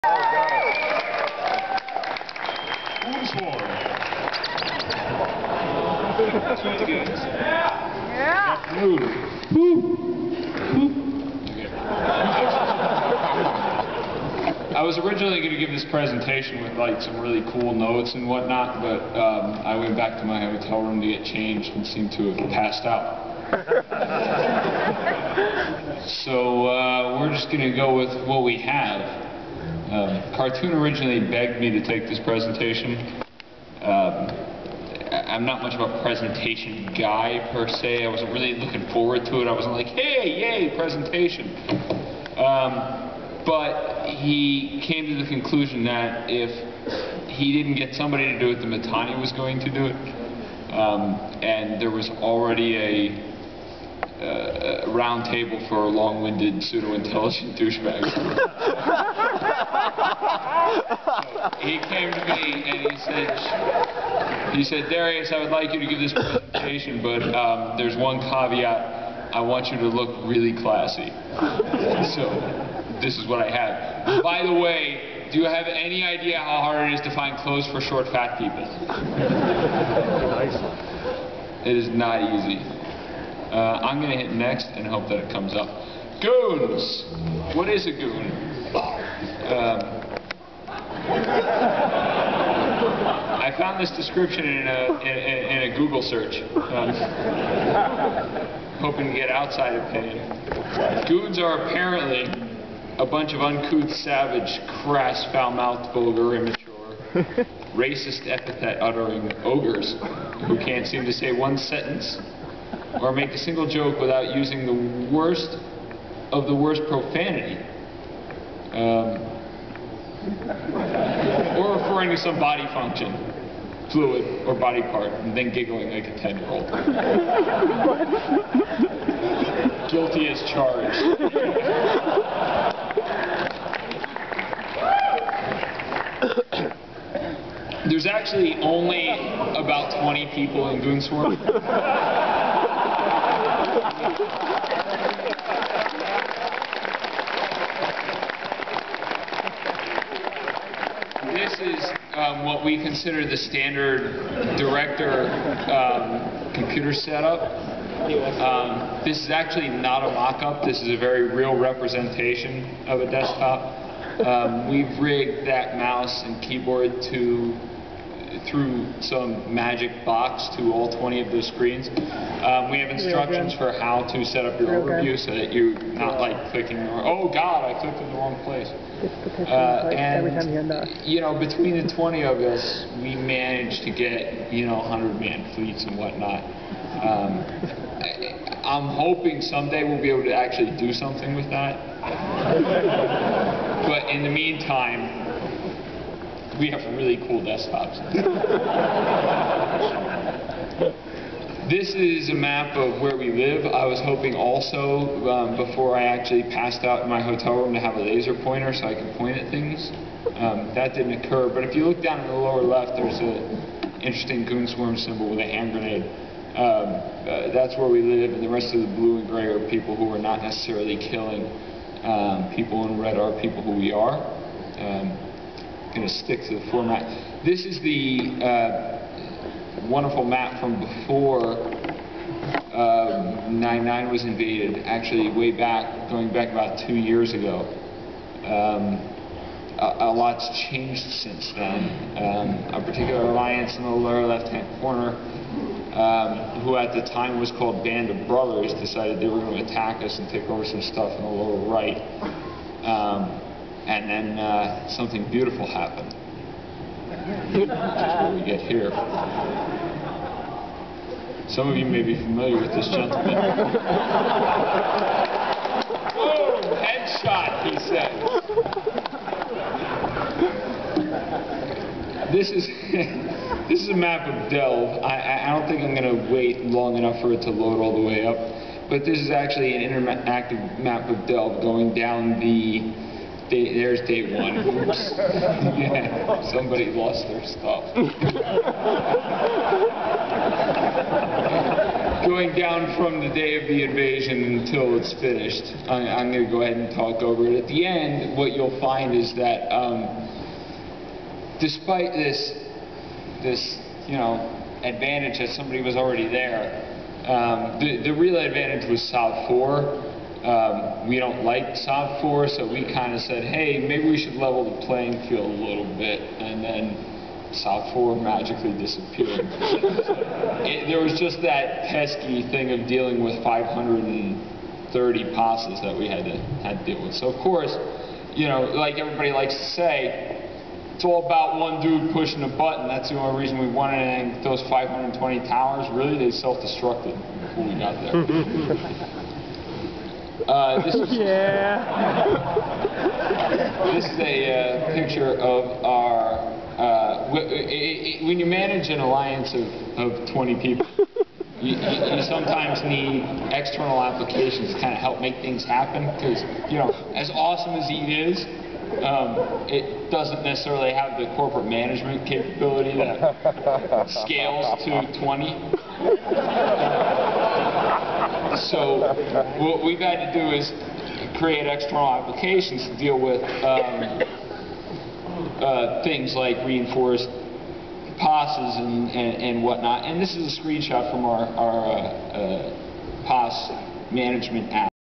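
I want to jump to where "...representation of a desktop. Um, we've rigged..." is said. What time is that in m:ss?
2:41.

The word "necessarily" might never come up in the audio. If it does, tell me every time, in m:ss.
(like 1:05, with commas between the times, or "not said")
3:40, 6:00.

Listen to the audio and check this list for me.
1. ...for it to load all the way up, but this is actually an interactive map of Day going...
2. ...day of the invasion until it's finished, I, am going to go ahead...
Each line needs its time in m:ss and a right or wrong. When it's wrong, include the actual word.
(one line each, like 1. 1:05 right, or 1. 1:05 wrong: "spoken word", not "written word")
1. 4:37 wrong: "Delve", not "Day"
2. 4:53 right.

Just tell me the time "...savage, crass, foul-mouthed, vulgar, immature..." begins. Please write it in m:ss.
1:43.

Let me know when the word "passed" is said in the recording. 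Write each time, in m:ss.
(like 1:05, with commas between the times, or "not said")
0:22, 3:26.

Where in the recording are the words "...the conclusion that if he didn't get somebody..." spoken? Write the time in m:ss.
0:45.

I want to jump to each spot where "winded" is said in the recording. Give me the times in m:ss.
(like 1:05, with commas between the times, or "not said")
0:55.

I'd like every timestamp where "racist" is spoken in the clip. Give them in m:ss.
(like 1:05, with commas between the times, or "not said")
1:47.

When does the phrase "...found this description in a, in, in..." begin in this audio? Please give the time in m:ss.
1:33.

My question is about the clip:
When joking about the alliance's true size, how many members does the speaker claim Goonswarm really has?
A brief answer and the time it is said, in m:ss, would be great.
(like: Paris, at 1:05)
20, at 2:19.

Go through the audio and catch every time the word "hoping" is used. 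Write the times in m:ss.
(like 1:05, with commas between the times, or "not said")
1:38, 3:08, 3:24.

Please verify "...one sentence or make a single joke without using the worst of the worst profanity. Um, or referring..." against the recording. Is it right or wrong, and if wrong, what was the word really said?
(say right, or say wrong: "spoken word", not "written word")
right.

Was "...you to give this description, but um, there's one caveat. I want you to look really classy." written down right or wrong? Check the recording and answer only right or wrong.
wrong.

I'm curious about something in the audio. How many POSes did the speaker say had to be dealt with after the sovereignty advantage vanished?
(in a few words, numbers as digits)
530.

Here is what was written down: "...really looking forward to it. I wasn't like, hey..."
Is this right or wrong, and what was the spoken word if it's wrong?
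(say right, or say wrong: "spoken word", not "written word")
right.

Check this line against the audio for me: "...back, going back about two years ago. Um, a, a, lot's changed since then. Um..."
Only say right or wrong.
right.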